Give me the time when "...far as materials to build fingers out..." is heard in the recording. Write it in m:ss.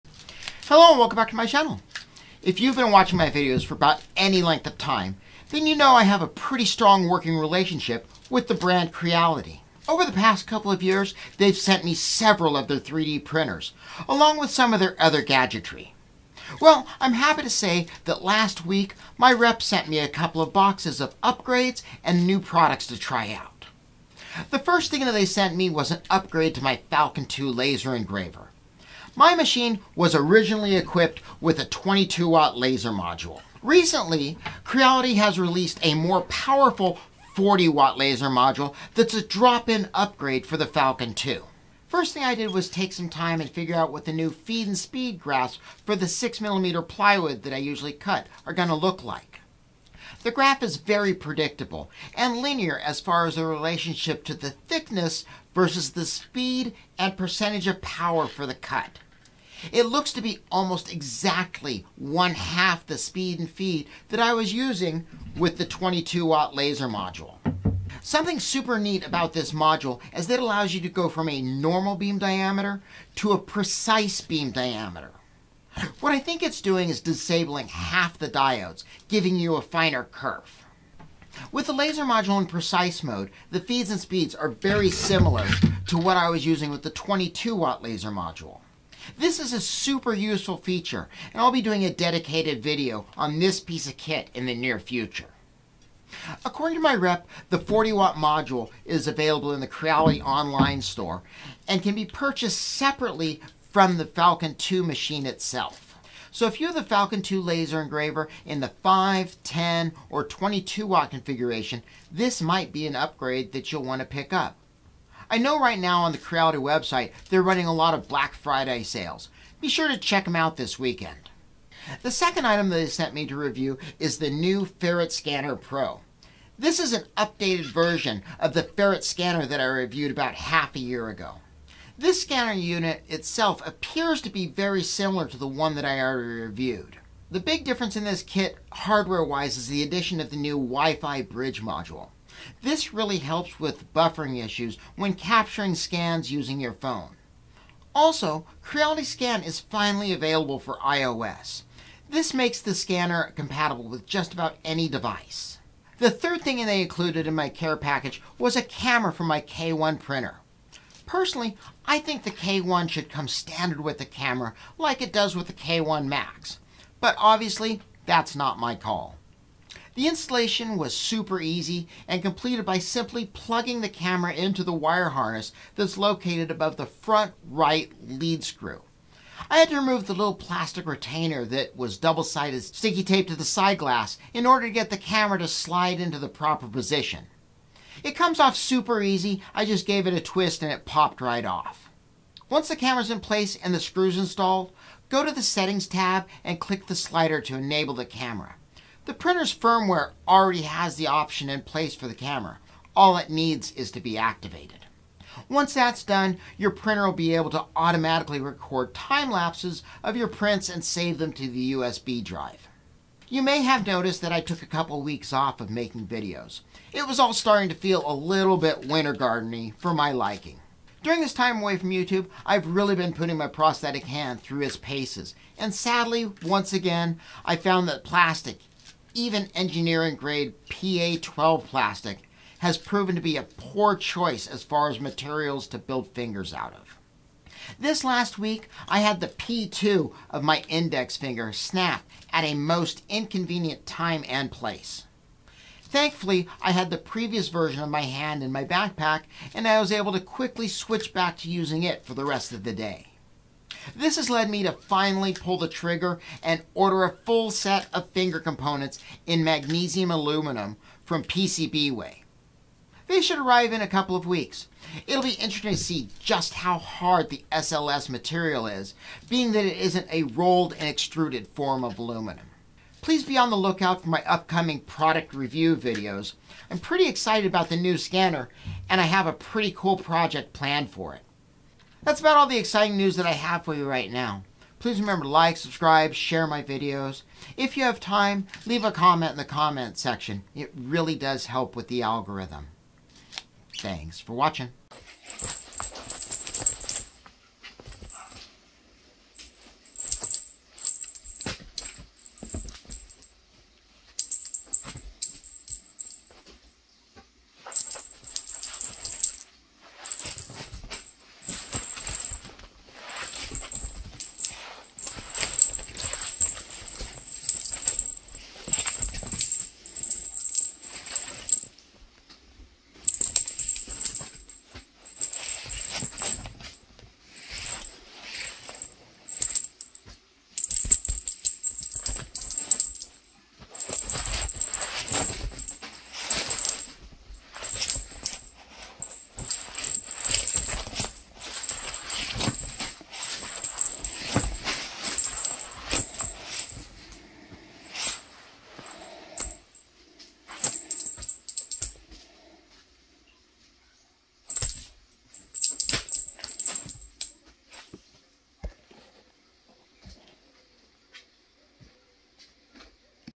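3:54.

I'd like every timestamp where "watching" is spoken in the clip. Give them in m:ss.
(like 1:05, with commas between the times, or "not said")
0:02, 4:54.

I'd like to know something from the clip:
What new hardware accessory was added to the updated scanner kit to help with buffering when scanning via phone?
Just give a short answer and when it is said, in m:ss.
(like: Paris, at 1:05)
Wi-Fi bridge module, at 2:20.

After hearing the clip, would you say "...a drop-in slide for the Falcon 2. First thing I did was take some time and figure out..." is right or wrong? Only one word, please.
wrong.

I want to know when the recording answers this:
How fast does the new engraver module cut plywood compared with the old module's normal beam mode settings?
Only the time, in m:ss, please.
1:01.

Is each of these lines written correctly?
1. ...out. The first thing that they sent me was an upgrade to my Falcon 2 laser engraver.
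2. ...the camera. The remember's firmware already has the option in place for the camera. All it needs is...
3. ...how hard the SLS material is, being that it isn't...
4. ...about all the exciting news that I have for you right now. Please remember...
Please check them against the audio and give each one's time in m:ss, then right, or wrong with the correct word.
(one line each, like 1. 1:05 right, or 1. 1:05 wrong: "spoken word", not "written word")
1. 0:23 right
2. 3:17 wrong: "printer", not "remember"
3. 4:26 right
4. 4:42 right.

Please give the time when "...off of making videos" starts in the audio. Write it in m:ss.
3:35.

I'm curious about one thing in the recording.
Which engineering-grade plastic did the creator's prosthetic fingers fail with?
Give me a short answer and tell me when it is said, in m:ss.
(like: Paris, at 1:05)
PA12, at 3:50.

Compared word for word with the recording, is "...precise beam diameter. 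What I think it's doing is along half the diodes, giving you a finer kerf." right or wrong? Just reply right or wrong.
wrong.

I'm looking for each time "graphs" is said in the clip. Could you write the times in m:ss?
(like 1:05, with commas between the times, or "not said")
0:45, 0:50.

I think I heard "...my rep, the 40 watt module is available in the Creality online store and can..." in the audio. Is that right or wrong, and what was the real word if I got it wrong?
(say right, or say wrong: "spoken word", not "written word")
right.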